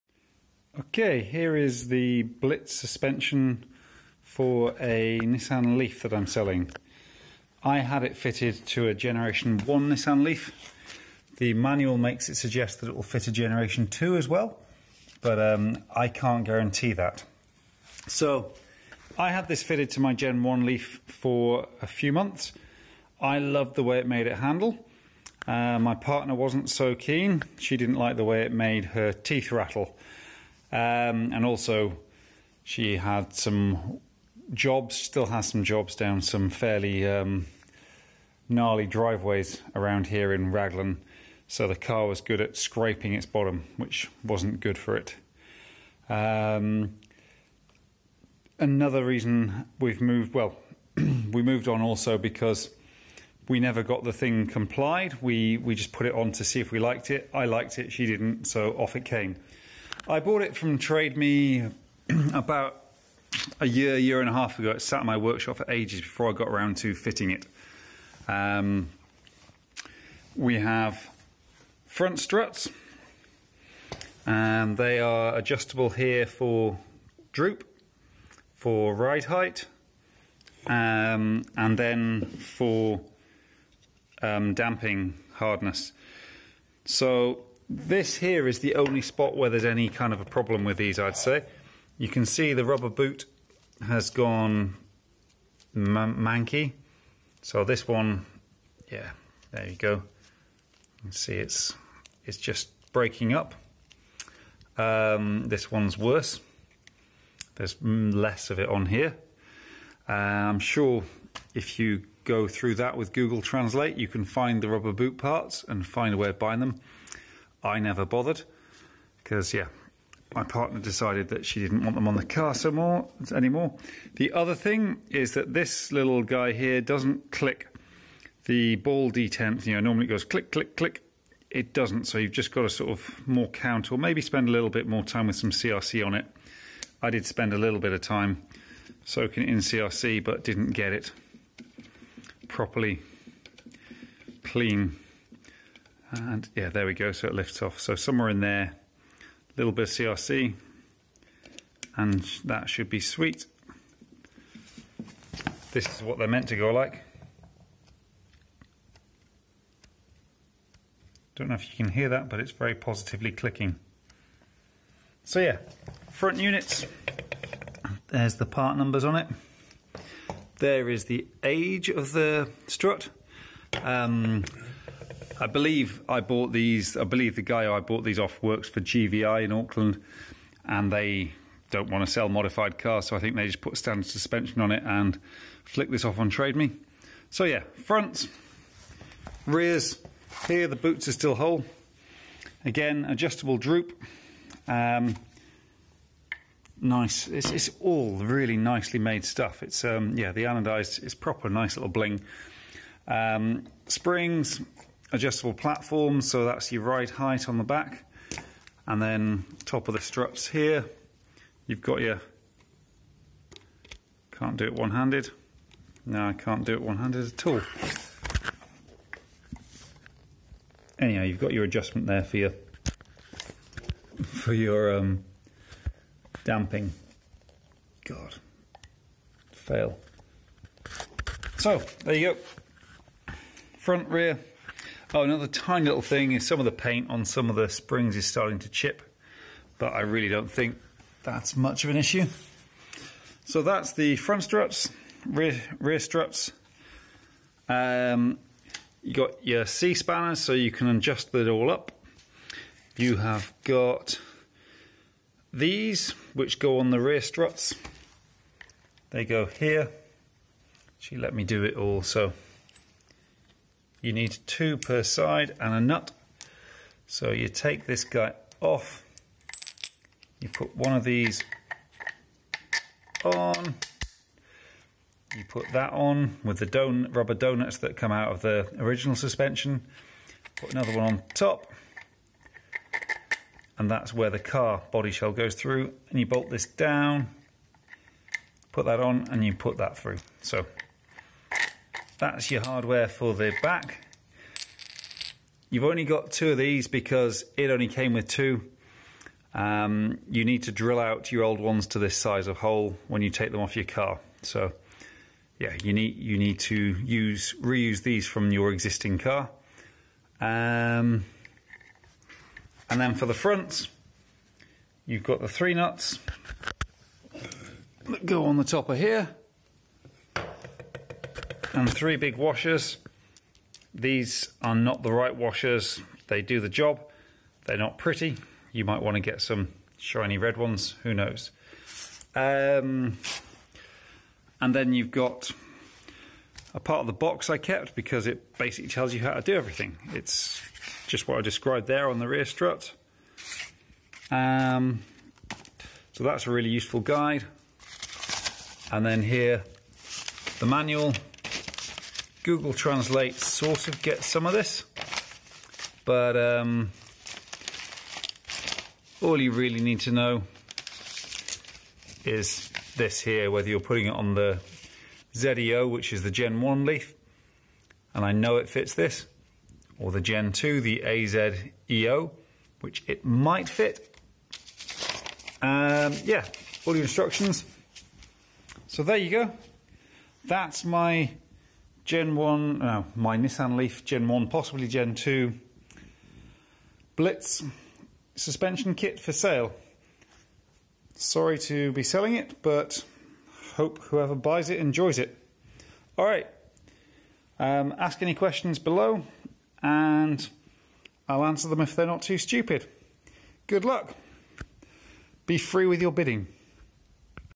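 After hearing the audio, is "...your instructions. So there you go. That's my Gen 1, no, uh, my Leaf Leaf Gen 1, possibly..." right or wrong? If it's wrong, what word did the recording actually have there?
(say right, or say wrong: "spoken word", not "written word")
wrong: "Nissan", not "Leaf".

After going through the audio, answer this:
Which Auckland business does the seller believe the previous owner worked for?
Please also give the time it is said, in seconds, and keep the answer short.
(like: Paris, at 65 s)
GVI, at 178 s.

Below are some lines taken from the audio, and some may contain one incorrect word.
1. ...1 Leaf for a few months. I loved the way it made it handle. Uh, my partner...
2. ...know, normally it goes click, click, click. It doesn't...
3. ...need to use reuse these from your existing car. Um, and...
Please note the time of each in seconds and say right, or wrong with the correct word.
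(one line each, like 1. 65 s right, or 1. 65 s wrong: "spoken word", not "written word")
1. 20 s right
2. 129 s right
3. 306 s right.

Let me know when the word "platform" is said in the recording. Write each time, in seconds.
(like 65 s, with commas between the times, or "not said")
205 s.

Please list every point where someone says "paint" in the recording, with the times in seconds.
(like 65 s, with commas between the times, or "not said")
236 s.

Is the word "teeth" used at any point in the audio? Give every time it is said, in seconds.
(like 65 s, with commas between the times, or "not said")
29 s.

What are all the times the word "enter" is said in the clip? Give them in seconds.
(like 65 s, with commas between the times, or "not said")
not said.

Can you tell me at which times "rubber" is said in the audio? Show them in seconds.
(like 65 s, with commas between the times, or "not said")
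92 s, 114 s, 277 s.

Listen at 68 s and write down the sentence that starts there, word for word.
Um, we have front struts, and they are adjustable here for droop, for ride height, um, and then for um, damping hardness.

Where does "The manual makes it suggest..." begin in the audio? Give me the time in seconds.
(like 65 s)
11 s.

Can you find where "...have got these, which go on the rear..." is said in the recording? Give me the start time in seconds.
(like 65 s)
253 s.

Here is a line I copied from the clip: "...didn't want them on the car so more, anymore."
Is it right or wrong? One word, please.
right.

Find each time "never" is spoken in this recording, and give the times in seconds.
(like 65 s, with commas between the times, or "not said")
53 s, 117 s.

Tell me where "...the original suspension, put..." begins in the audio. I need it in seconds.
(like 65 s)
278 s.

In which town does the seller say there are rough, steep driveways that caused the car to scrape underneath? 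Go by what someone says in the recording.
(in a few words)
Raglan.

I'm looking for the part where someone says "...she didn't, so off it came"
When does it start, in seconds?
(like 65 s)
57 s.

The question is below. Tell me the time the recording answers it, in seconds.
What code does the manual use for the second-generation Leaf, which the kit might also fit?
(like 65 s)
371 s.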